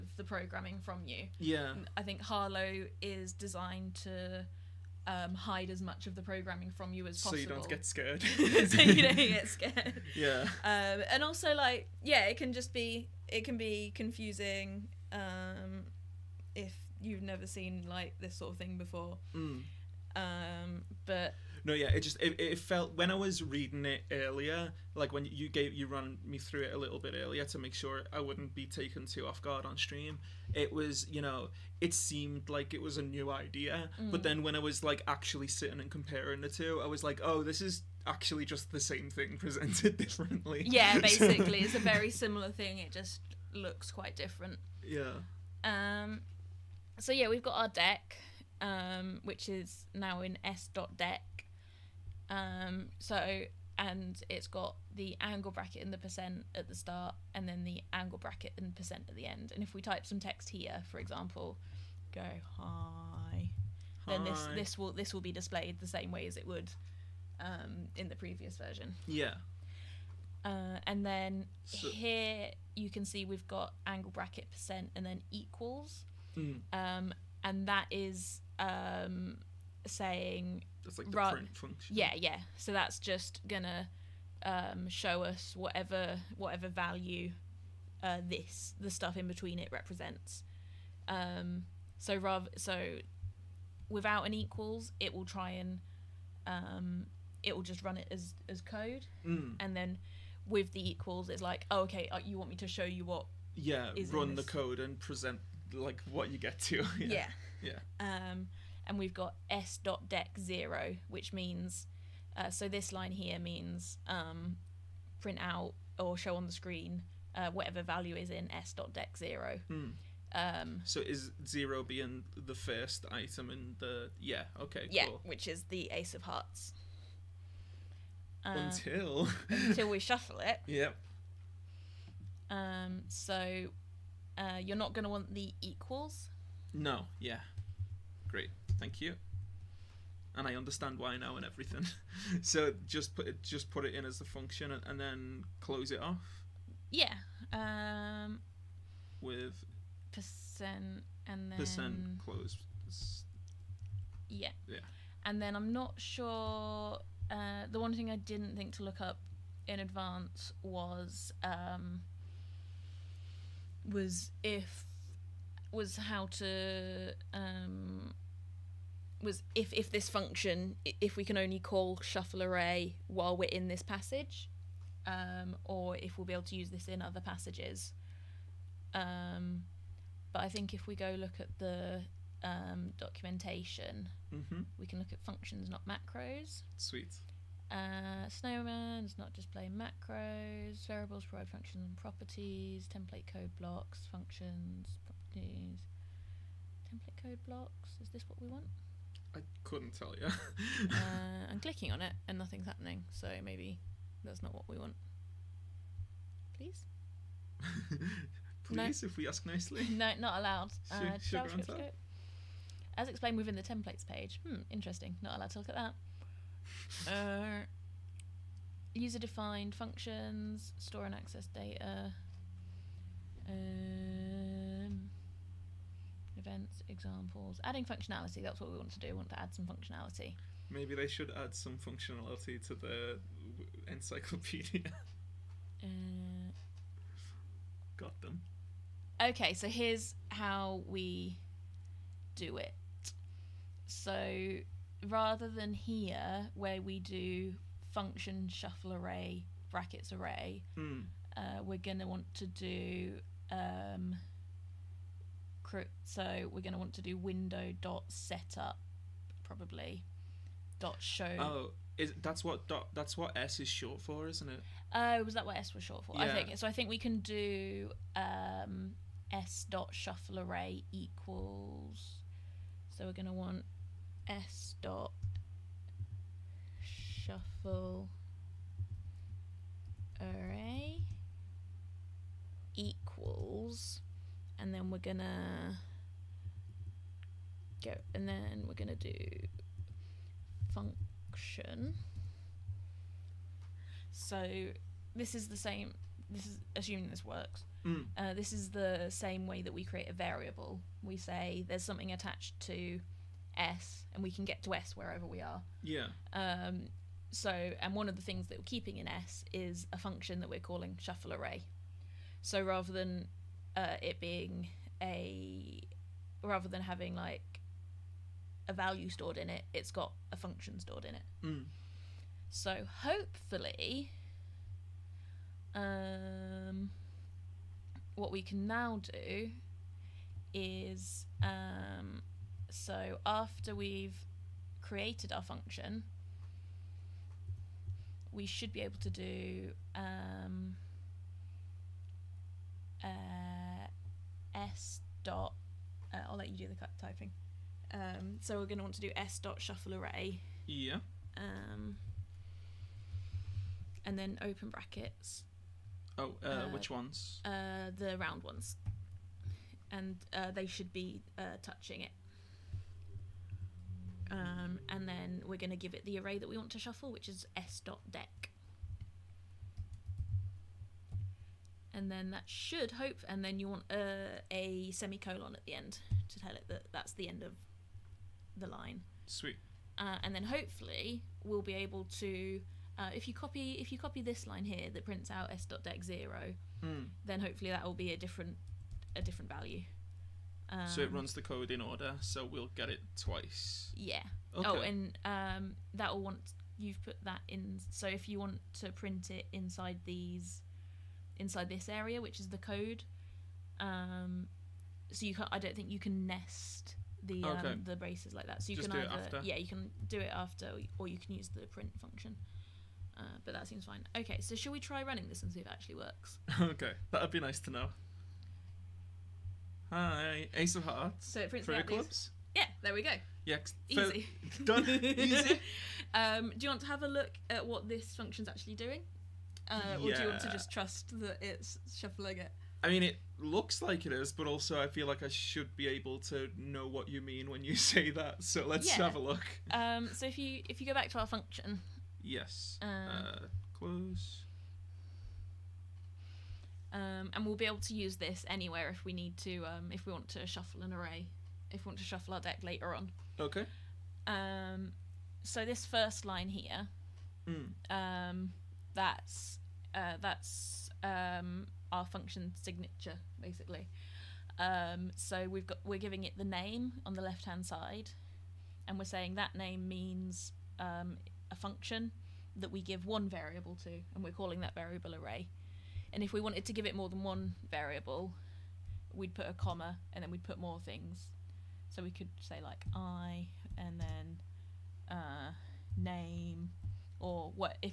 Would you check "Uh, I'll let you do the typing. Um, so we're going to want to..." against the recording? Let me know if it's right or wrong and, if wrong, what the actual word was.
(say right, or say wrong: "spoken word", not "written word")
right.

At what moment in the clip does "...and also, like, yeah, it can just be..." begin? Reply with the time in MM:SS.
00:11.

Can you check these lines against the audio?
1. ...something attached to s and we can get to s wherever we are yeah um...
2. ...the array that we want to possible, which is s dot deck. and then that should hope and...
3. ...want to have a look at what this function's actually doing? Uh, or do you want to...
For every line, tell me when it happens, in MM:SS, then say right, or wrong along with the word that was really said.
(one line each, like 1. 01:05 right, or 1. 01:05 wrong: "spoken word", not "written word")
1. 05:01 right
2. 06:06 wrong: "shuffle", not "possible"
3. 07:06 right.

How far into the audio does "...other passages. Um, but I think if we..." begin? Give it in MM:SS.
02:57.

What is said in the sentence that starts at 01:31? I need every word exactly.
Um, so rather so without an equals, it will try and um, it will just run it as as code, mm.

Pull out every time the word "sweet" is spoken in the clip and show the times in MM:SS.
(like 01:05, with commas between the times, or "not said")
03:06, 06:19.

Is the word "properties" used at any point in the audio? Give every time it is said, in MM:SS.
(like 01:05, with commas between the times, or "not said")
03:11.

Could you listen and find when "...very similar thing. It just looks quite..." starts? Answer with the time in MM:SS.
00:41.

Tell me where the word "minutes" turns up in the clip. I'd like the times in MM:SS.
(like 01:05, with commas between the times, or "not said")
not said.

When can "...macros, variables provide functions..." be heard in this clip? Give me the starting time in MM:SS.
03:09.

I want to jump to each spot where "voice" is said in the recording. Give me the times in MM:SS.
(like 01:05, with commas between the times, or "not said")
not said.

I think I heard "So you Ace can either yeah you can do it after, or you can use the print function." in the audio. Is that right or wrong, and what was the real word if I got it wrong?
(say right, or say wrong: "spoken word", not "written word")
wrong: "Just", not "Ace".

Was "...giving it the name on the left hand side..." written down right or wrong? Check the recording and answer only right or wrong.
right.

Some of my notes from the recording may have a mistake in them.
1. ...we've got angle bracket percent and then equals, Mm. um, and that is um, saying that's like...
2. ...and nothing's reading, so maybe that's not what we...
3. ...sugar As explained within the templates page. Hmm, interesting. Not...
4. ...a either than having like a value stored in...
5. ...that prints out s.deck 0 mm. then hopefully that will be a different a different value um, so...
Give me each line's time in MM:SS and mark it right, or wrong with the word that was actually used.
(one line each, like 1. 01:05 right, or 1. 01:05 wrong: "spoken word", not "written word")
1. 01:13 right
2. 03:22 wrong: "happening", not "reading"
3. 03:31 right
4. 05:15 wrong: "rather", not "either"
5. 06:24 right.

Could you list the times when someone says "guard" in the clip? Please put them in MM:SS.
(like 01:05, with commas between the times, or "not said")
00:29.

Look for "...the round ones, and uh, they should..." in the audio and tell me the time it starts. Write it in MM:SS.
05:57.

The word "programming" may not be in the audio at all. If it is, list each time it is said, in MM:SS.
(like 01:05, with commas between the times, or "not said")
00:00, 00:06.